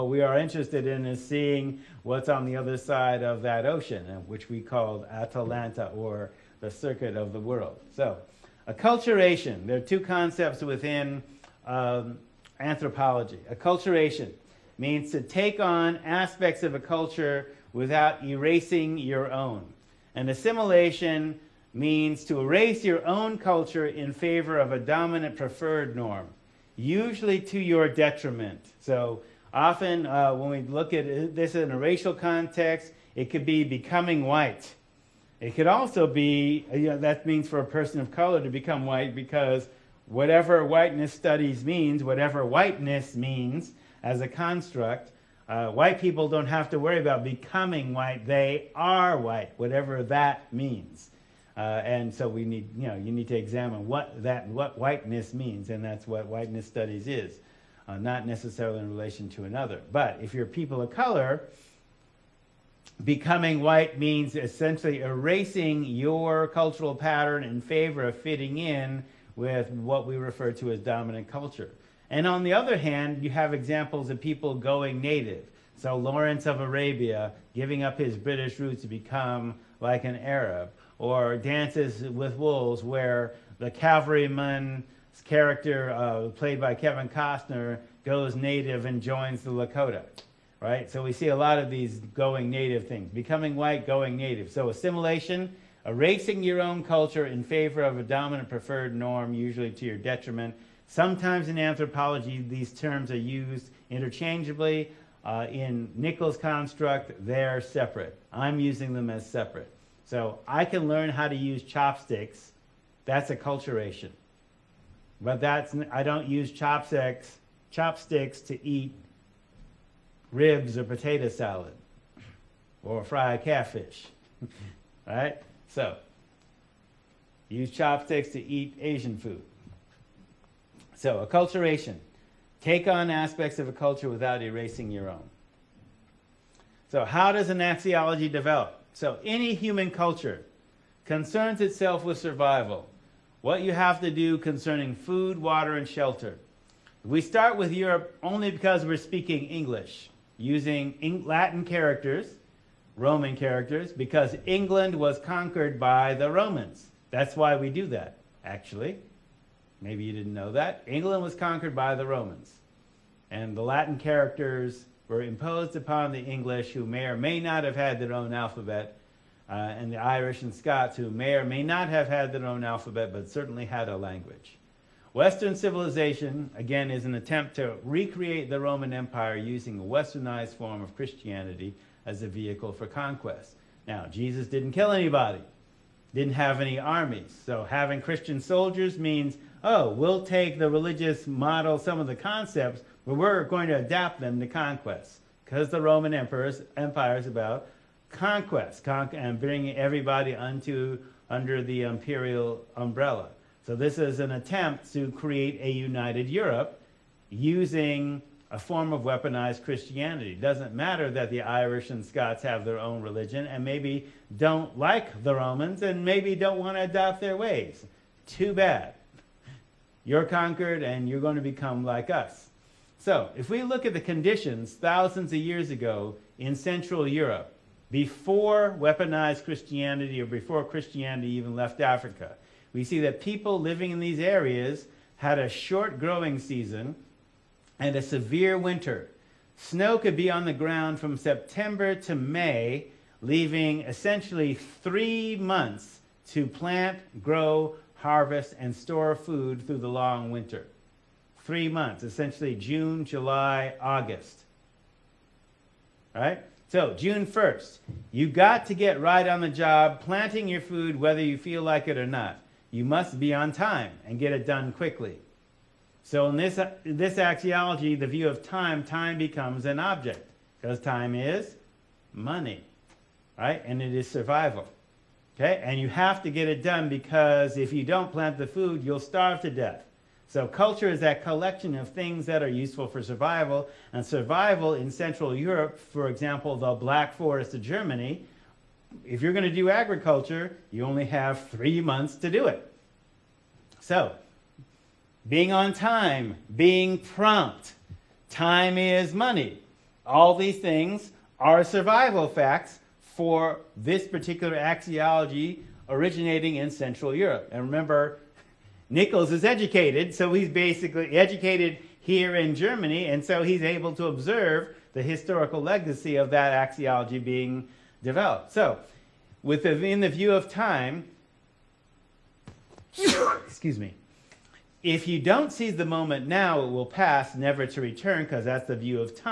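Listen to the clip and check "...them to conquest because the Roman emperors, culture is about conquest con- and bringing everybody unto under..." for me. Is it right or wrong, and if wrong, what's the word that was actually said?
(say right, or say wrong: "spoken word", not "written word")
wrong: "empire", not "culture".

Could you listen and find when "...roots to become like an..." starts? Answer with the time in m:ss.
1:18.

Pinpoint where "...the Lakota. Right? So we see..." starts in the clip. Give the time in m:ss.
1:29.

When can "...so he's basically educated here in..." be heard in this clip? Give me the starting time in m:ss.
5:10.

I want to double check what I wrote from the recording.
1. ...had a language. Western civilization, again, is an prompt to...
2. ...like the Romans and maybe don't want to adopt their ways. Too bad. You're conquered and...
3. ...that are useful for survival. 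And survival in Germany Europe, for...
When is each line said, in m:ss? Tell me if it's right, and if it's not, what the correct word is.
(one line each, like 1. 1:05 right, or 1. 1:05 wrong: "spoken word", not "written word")
1. 2:53 wrong: "attempt", not "prompt"
2. 3:34 right
3. 4:42 wrong: "Central", not "Germany".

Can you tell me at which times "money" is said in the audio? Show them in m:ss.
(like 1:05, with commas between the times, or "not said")
4:32, 4:59.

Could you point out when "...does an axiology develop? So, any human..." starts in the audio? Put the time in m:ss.
2:17.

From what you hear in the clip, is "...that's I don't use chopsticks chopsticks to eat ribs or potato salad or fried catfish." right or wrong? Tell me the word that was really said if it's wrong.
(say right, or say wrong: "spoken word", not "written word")
right.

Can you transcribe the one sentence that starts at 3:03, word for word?
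Now, Jesus didn't kill anybody, didn't have any armies.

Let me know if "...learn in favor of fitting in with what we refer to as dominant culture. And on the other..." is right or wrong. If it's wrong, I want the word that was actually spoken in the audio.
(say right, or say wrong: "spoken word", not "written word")
wrong: "pattern", not "learn".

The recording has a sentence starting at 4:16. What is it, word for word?
Right, So, June 1st, you got to get right on the job planting your food whether you feel like it or not.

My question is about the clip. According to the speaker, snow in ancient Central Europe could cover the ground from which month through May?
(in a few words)
September.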